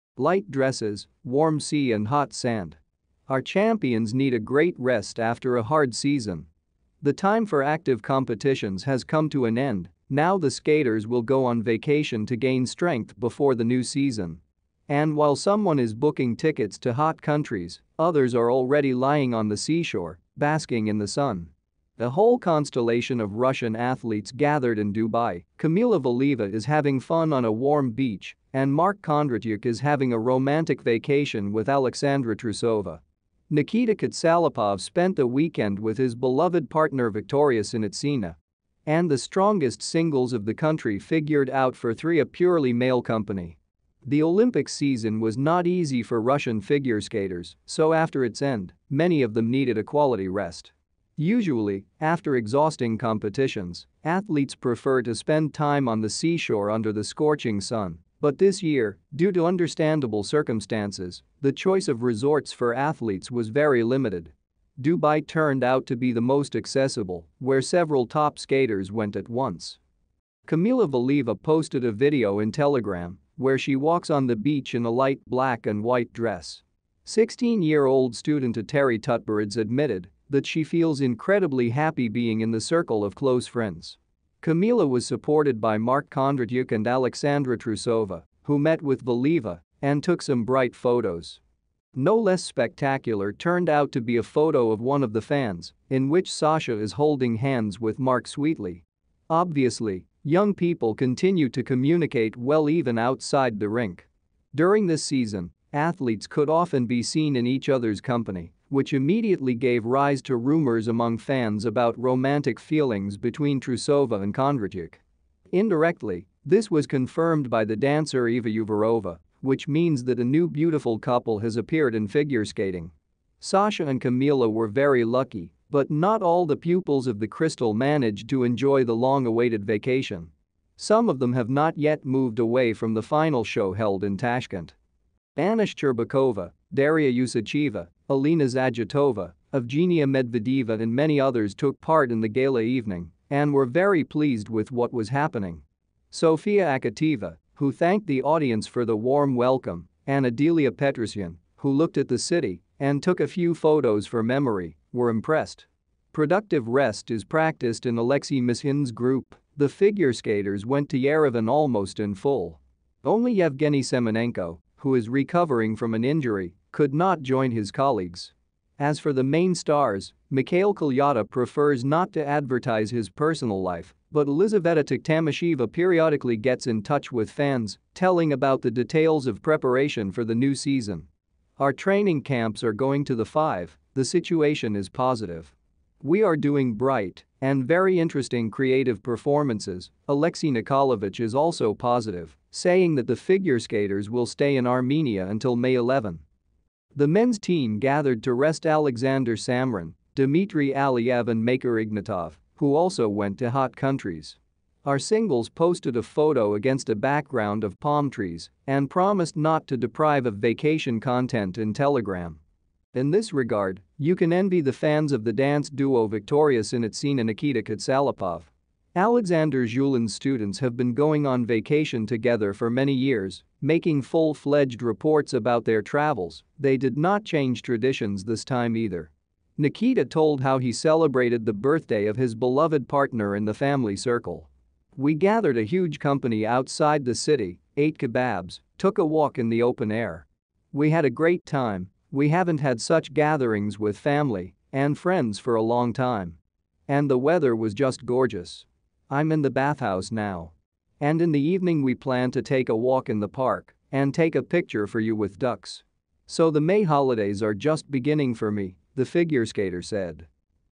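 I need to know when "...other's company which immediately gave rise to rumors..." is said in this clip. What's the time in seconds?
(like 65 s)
107 s.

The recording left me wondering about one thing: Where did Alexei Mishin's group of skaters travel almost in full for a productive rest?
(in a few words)
Yerevan.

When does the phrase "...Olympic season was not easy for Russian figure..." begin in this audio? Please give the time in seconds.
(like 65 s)
44 s.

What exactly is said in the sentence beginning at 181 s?
Our training camps are going to the five, the situation is positive.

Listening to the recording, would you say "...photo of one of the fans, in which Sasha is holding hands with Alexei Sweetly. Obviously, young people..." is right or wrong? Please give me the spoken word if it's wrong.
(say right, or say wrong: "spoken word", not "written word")
wrong: "Mark", not "Alexei".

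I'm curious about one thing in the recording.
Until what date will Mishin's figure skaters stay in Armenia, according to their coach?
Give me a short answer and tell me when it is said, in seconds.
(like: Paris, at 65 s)
May 11, at 195 s.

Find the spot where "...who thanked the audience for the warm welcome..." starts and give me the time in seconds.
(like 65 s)
147 s.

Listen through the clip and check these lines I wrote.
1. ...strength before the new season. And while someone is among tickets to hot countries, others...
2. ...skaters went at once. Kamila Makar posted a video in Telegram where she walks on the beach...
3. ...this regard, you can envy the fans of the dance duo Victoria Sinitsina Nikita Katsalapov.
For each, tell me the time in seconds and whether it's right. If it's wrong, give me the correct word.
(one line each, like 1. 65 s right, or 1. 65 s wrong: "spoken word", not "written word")
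1. 12 s wrong: "booking", not "among"
2. 68 s wrong: "Valieva", not "Makar"
3. 213 s right.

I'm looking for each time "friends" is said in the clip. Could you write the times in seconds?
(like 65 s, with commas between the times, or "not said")
83 s, 244 s.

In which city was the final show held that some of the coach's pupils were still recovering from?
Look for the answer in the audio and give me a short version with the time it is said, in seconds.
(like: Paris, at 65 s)
Tashkent, at 134 s.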